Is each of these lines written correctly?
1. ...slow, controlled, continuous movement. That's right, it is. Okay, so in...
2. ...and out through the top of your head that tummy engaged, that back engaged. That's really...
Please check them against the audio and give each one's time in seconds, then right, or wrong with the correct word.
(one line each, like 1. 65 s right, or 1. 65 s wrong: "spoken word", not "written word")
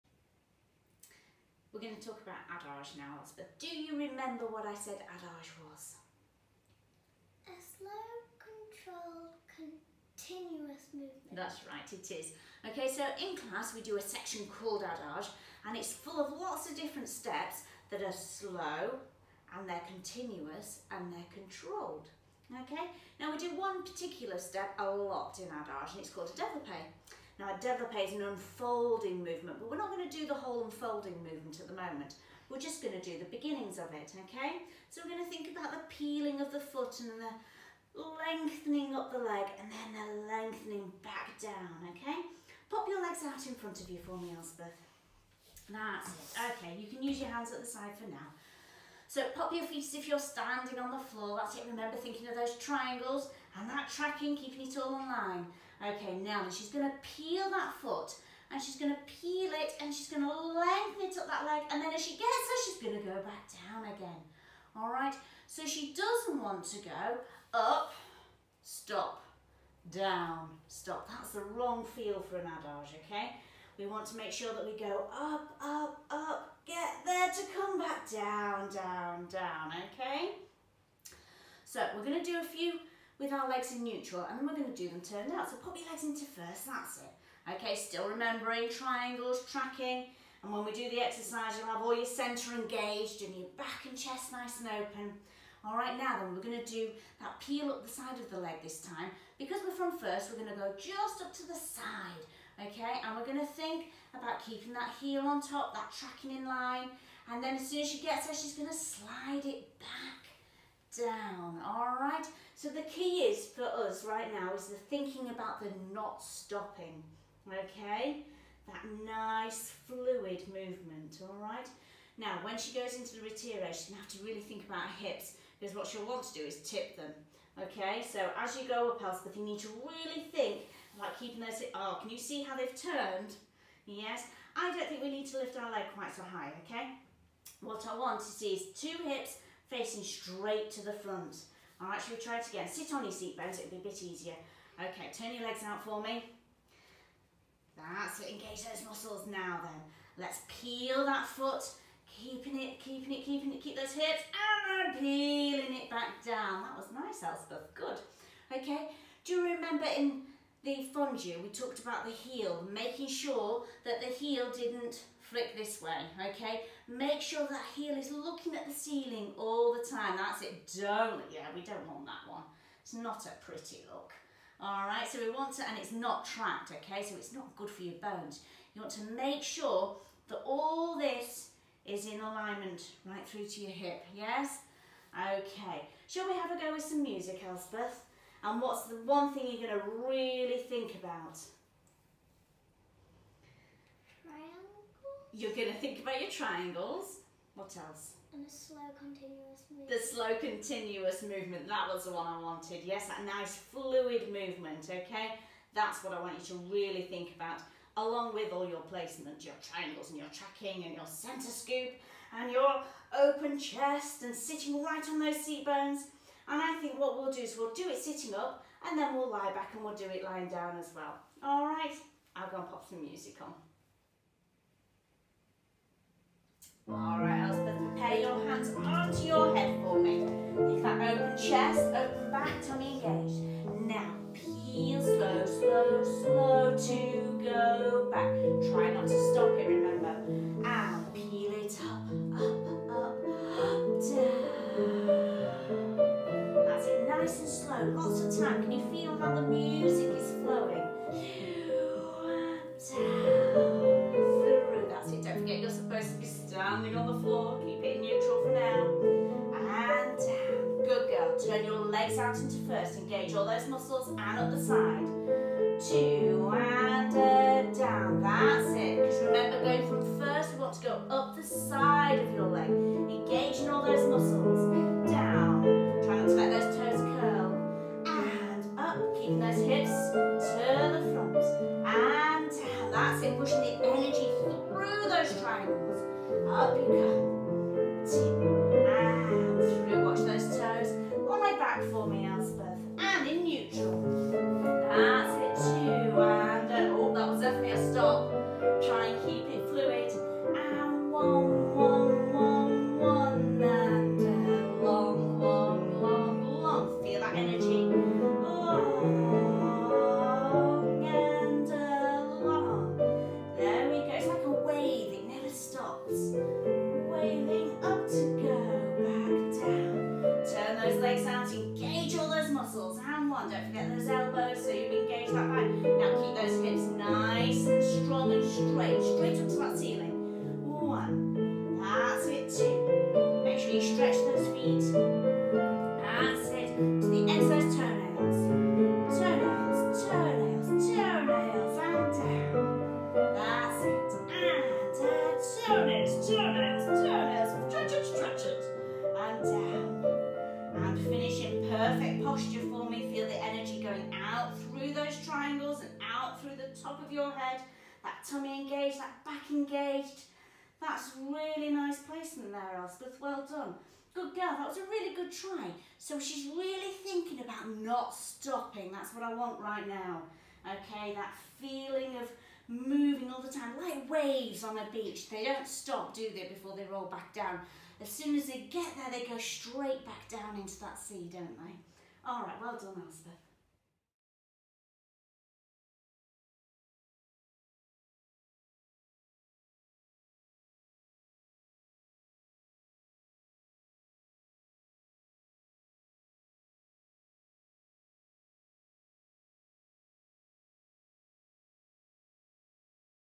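1. 7 s right
2. 355 s right.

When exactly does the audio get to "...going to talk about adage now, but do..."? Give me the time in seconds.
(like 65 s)
1 s.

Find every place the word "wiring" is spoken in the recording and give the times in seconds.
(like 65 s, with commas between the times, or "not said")
not said.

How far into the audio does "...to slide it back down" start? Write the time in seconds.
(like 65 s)
108 s.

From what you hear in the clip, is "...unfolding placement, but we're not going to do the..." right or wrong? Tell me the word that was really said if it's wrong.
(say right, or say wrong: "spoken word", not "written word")
wrong: "movement", not "placement".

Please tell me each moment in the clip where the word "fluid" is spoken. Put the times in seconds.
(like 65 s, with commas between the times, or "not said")
119 s, 203 s.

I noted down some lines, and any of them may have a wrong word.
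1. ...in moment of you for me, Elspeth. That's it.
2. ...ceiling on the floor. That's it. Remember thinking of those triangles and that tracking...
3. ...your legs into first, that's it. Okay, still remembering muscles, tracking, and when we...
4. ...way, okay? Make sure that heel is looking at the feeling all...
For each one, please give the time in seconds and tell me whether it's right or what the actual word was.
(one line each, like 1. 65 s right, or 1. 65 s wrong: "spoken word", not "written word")
1. 43 s wrong: "front", not "moment"
2. 50 s wrong: "standing", not "ceiling"
3. 85 s wrong: "triangles", not "muscles"
4. 165 s wrong: "ceiling", not "feeling".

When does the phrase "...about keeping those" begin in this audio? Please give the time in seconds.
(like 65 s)
130 s.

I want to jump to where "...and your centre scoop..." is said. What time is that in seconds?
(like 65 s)
210 s.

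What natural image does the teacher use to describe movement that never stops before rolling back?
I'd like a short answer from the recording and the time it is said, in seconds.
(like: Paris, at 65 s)
waves on a beach, at 374 s.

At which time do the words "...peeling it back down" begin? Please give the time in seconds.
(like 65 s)
154 s.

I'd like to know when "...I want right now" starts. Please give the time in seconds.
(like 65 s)
369 s.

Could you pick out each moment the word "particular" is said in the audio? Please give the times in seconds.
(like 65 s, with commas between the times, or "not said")
23 s.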